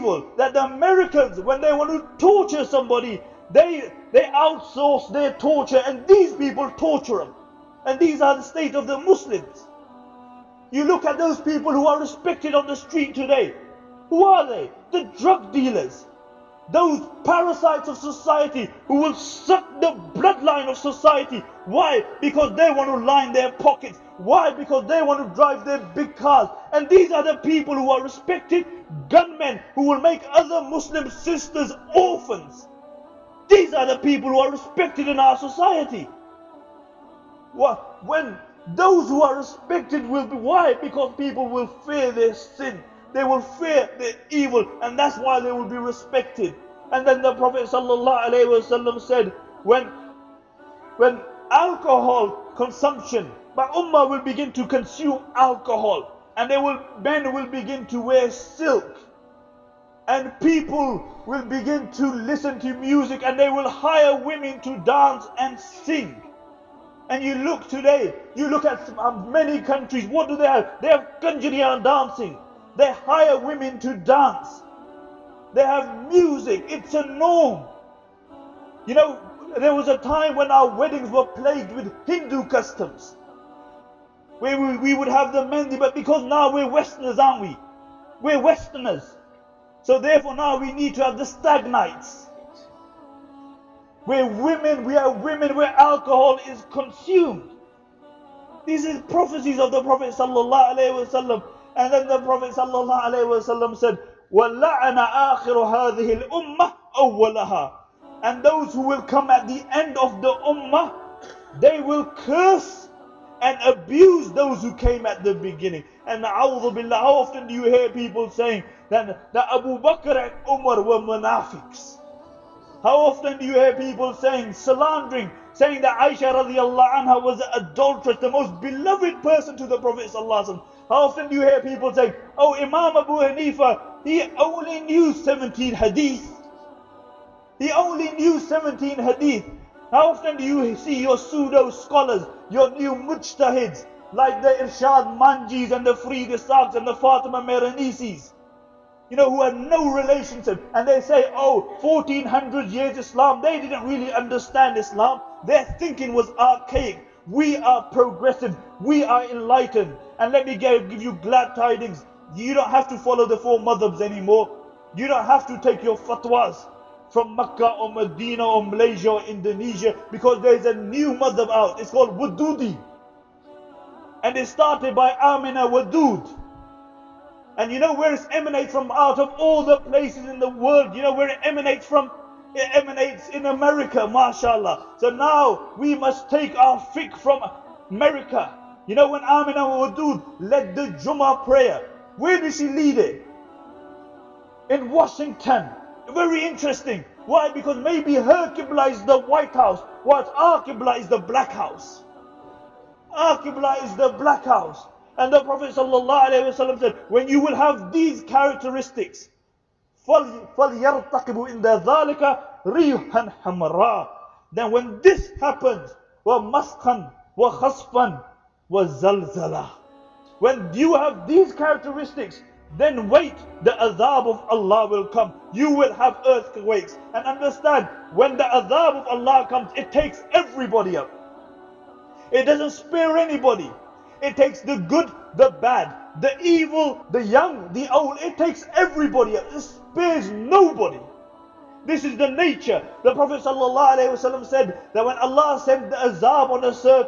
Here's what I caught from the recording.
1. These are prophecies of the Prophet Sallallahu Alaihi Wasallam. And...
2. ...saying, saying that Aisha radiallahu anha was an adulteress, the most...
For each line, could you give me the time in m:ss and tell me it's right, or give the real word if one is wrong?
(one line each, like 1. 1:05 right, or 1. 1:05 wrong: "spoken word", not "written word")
1. 1:38 right
2. 2:04 wrong: "slandering", not "saying".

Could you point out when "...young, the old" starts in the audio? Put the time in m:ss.
3:57.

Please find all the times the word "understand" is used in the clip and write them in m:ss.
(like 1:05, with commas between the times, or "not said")
2:34, 3:47.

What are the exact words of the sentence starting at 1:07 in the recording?
And you look today, you look at um, many countries, what do they have?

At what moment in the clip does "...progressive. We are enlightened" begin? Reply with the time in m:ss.
2:37.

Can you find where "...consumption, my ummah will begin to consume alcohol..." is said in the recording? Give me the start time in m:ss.
0:52.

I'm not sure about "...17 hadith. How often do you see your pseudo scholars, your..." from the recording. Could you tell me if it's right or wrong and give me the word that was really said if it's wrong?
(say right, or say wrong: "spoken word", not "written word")
right.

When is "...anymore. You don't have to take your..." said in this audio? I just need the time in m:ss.
2:44.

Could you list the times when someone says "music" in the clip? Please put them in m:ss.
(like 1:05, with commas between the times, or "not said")
1:02, 1:16.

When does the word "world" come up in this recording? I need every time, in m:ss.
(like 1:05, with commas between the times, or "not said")
3:00.